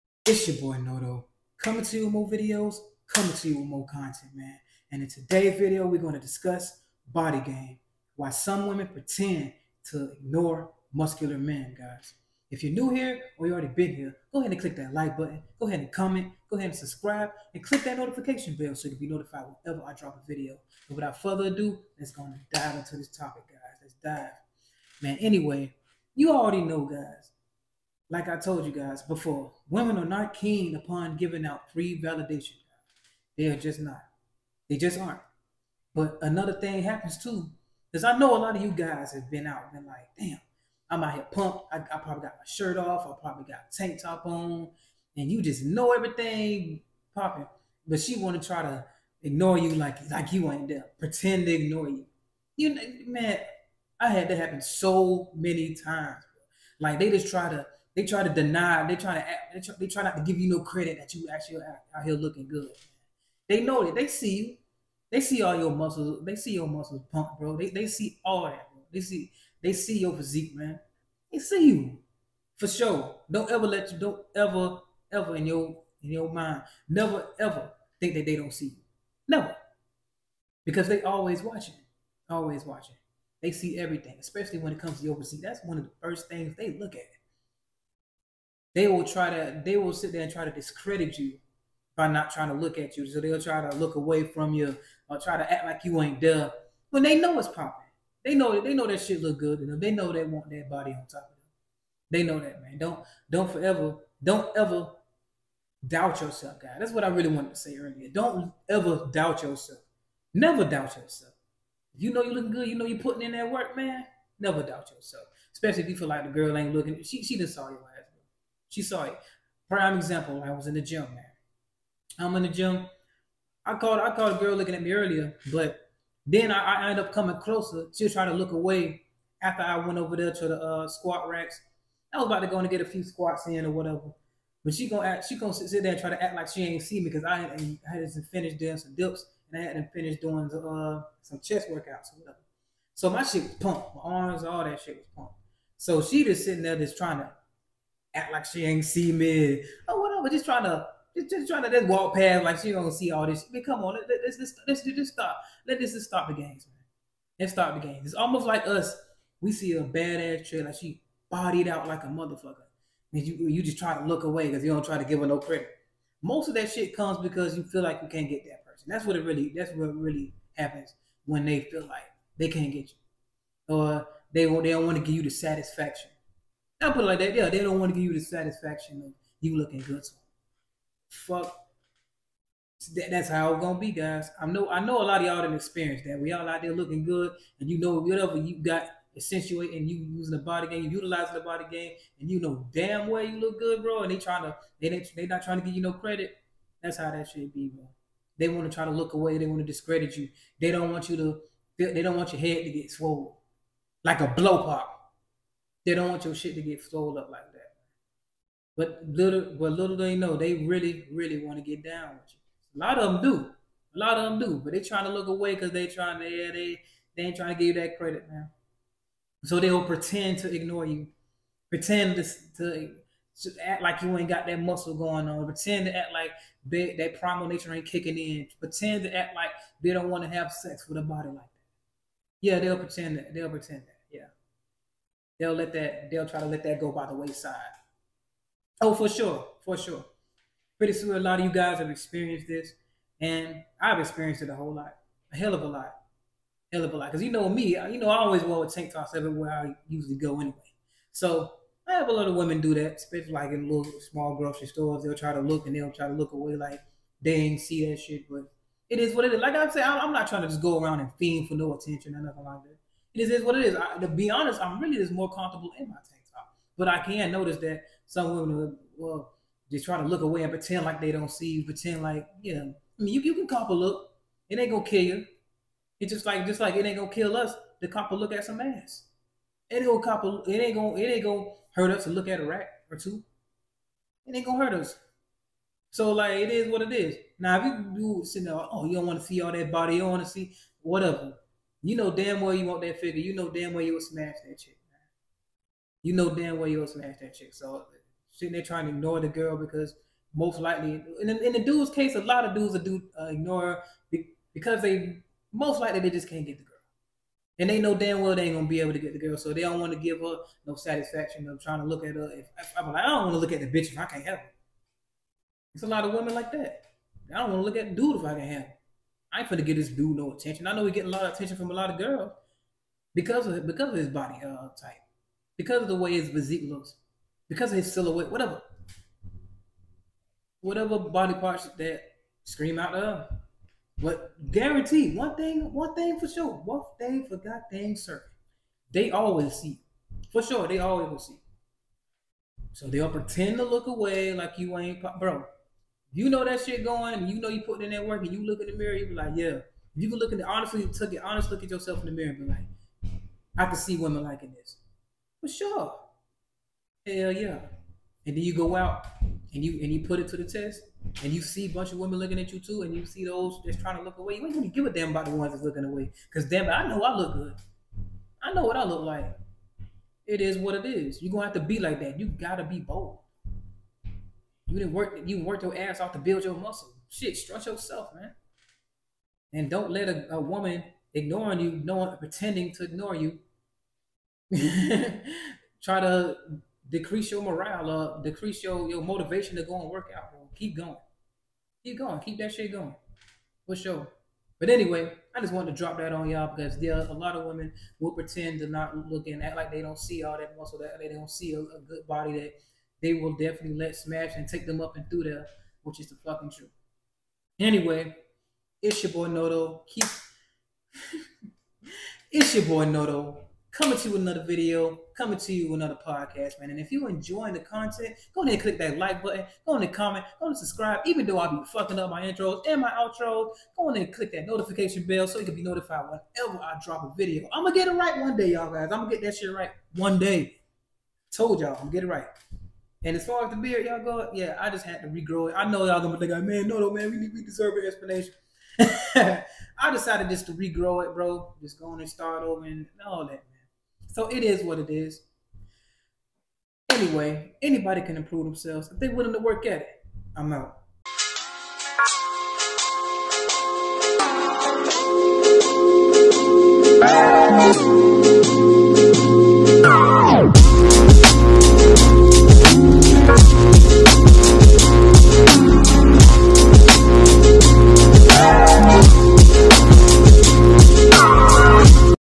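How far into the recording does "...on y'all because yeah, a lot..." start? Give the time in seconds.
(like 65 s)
396 s.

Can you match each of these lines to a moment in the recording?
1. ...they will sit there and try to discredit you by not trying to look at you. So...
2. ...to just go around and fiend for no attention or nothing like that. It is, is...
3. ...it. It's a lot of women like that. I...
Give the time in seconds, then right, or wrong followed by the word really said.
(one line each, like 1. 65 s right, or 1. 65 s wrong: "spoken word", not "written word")
1. 89 s right
2. 260 s right
3. 314 s right.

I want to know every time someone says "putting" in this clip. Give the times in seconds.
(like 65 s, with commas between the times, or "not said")
112 s.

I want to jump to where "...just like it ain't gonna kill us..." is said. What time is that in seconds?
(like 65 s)
276 s.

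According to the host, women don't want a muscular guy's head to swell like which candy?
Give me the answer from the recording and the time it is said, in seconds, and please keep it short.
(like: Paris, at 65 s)
blow pop, at 204 s.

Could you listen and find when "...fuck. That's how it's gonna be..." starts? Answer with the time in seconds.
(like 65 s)
181 s.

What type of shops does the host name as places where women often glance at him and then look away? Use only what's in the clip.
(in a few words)
small grocery stores.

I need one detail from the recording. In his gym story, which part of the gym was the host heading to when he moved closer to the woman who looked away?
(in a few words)
squat racks.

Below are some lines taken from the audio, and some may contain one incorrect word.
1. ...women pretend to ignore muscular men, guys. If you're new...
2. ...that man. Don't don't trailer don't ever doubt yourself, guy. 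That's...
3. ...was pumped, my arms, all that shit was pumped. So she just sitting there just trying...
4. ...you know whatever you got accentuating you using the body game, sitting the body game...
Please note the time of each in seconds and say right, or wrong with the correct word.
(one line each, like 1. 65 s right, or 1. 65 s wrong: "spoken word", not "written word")
1. 8 s right
2. 102 s wrong: "forever", not "trailer"
3. 143 s right
4. 187 s wrong: "utilizing", not "sitting".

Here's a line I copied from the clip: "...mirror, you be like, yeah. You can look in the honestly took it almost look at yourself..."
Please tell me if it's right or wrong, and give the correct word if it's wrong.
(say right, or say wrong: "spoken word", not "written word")
wrong: "honest", not "almost".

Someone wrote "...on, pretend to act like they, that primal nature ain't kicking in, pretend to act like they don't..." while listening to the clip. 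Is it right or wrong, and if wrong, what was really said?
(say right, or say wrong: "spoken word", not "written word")
right.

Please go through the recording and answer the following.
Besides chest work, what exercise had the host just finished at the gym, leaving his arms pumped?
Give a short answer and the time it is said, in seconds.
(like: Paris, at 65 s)
dips, at 138 s.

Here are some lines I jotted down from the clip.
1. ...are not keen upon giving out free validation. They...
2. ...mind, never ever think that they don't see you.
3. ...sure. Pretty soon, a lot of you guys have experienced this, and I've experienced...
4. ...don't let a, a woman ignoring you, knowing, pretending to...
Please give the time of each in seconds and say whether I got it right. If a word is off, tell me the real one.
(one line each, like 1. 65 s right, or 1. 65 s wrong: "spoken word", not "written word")
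1. 29 s right
2. 76 s right
3. 239 s right
4. 379 s right.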